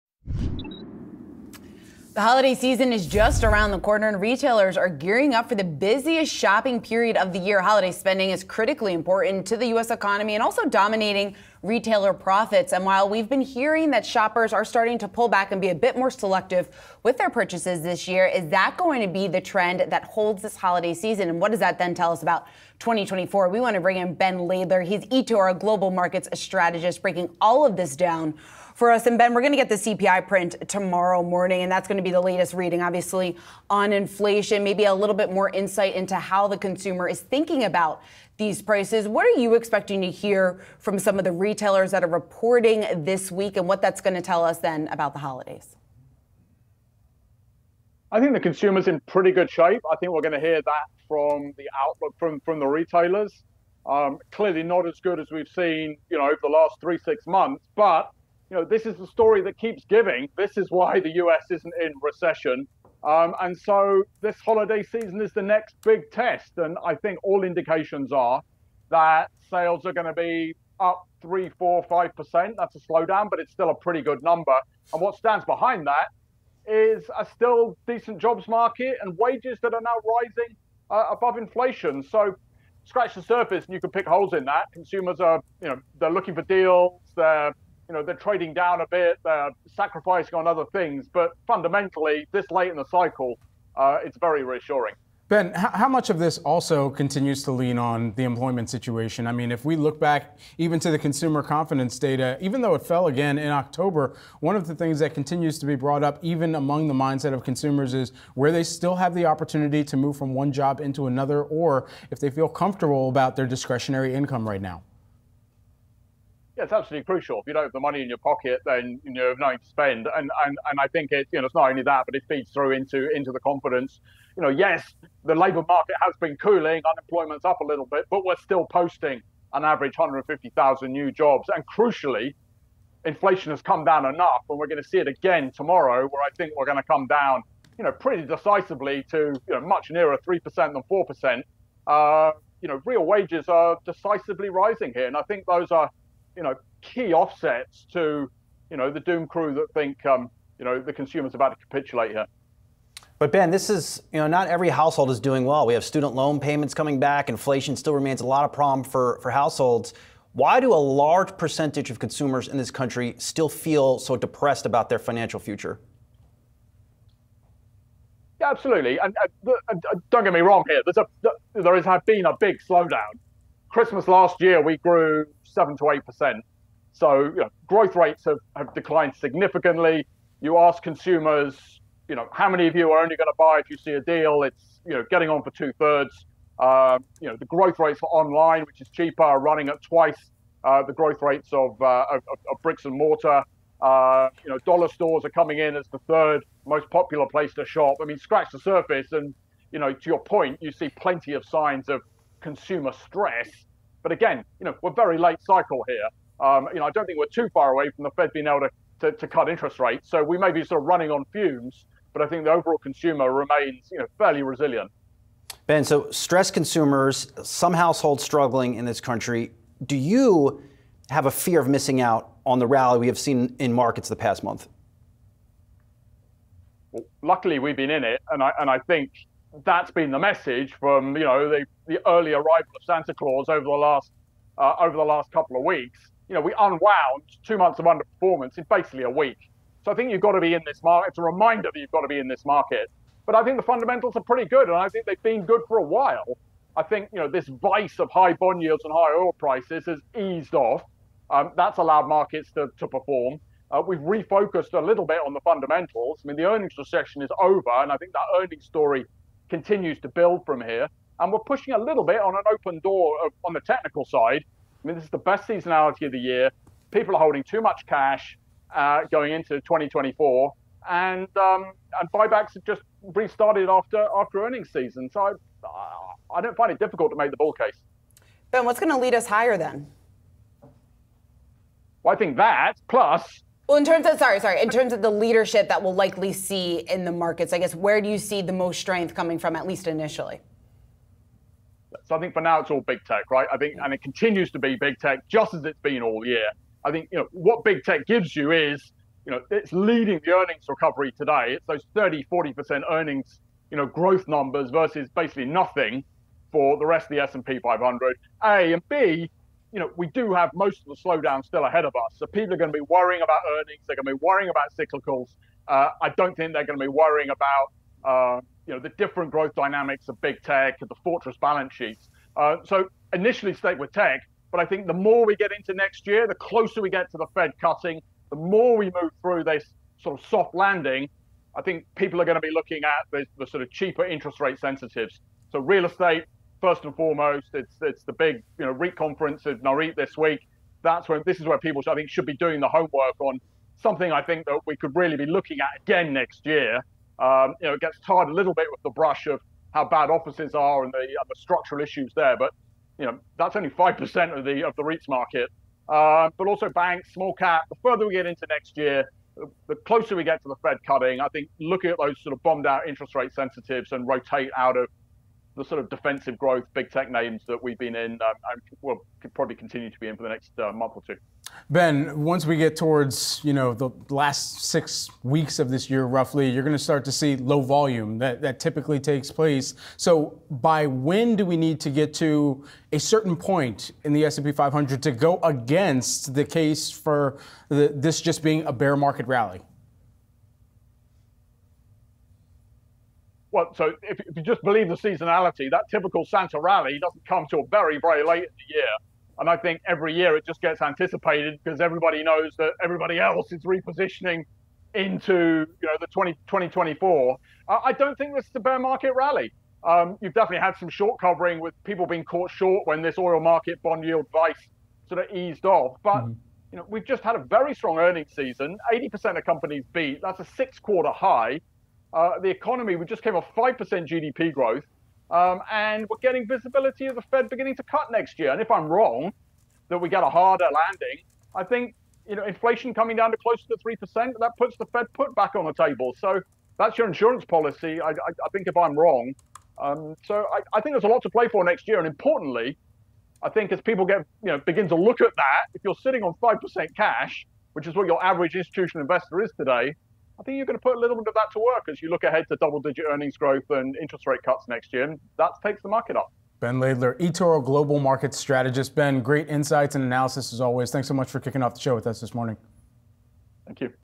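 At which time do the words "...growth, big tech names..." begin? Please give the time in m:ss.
6:06.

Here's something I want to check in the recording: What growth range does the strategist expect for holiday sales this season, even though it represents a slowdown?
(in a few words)
3-5%.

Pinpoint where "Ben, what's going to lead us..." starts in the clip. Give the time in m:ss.
4:38.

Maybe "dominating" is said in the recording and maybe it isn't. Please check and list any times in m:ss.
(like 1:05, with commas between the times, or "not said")
0:10.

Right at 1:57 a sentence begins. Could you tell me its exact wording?
If you don't have the money in your pocket, then you know, have nothing to spend.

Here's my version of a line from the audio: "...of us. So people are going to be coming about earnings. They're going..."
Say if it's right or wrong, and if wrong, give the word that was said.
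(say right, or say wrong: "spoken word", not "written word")
wrong: "worrying", not "coming".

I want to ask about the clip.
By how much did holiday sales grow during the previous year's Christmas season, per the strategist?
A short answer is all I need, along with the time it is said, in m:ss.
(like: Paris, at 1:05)
7-8%, at 2:55.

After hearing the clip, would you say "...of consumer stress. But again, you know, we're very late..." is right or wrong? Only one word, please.
right.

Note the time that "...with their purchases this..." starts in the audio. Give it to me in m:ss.
0:17.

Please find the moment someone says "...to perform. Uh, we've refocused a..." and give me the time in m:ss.
4:12.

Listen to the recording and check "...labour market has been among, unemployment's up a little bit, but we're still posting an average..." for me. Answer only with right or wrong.
wrong.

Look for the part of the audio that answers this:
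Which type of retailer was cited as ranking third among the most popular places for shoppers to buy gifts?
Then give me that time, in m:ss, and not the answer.
3:14.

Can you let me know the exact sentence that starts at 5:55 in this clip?
Uh, but also banks, small cap.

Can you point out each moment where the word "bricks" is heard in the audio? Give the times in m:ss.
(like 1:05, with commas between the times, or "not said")
3:12.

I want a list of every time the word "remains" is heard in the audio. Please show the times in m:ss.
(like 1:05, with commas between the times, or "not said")
2:37, 3:33.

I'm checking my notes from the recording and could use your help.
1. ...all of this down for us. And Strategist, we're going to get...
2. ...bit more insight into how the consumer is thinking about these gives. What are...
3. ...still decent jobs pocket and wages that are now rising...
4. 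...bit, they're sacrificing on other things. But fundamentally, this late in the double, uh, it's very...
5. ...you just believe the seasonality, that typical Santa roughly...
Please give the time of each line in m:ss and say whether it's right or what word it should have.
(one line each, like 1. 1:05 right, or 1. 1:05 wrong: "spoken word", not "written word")
1. 0:27 wrong: "Ben", not "Strategist"
2. 0:35 wrong: "prices", not "gives"
3. 1:17 wrong: "market", not "pocket"
4. 1:28 wrong: "cycle", not "double"
5. 6:34 wrong: "rally", not "roughly".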